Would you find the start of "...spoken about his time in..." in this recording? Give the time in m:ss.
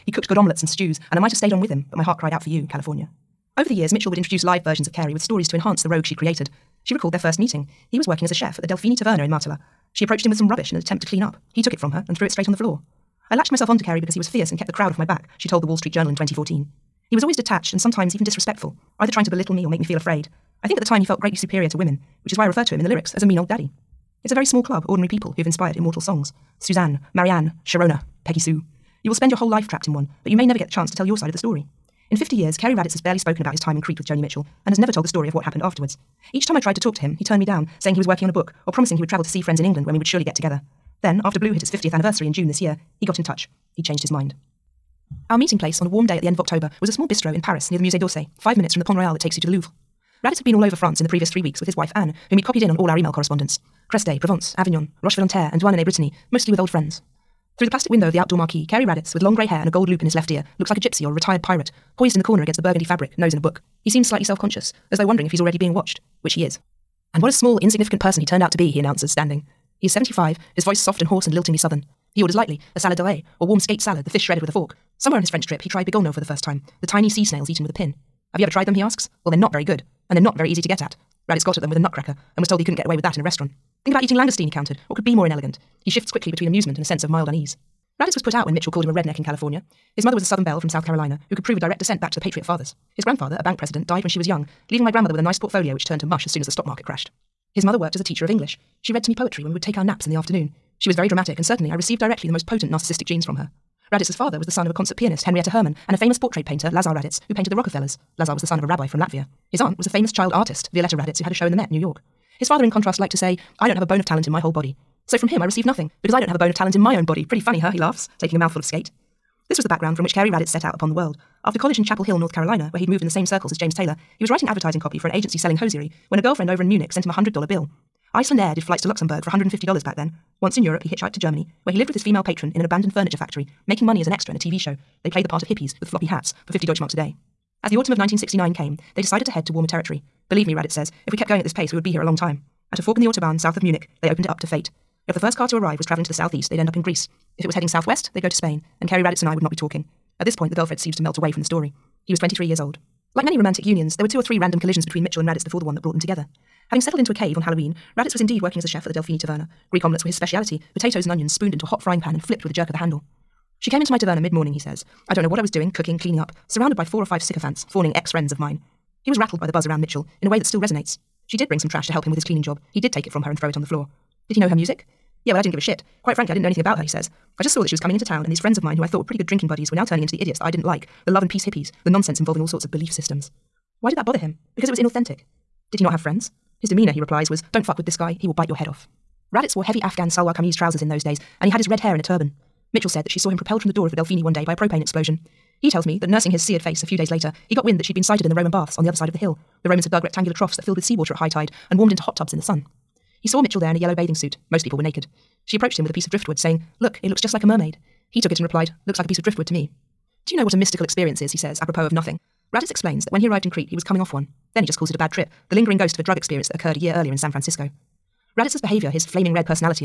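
0:33.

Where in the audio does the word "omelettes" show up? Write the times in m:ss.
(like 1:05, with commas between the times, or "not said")
0:00, 2:39.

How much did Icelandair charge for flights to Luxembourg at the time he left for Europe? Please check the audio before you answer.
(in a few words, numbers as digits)
$150.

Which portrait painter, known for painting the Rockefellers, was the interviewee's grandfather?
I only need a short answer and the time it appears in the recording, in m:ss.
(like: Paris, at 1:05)
Lazar Raditz, at 1:46.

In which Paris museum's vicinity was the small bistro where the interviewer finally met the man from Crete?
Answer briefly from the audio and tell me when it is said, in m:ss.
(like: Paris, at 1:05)
Musée d'Orsay, at 0:47.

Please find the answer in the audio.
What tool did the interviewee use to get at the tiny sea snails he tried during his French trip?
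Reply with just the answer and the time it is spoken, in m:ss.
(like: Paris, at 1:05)
A nutcracker, at 1:21.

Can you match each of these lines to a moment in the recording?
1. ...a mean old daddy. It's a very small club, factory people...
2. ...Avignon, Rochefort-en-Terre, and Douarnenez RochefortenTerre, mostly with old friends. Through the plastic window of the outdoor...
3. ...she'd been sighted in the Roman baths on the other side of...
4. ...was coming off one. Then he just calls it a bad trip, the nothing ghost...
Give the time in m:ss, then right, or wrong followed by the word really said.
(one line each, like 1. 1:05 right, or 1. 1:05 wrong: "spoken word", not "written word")
1. 0:23 wrong: "ordinary", not "factory"
2. 0:54 wrong: "Brittany", not "RochefortenTerre"
3. 3:17 right
4. 3:33 wrong: "lingering", not "nothing".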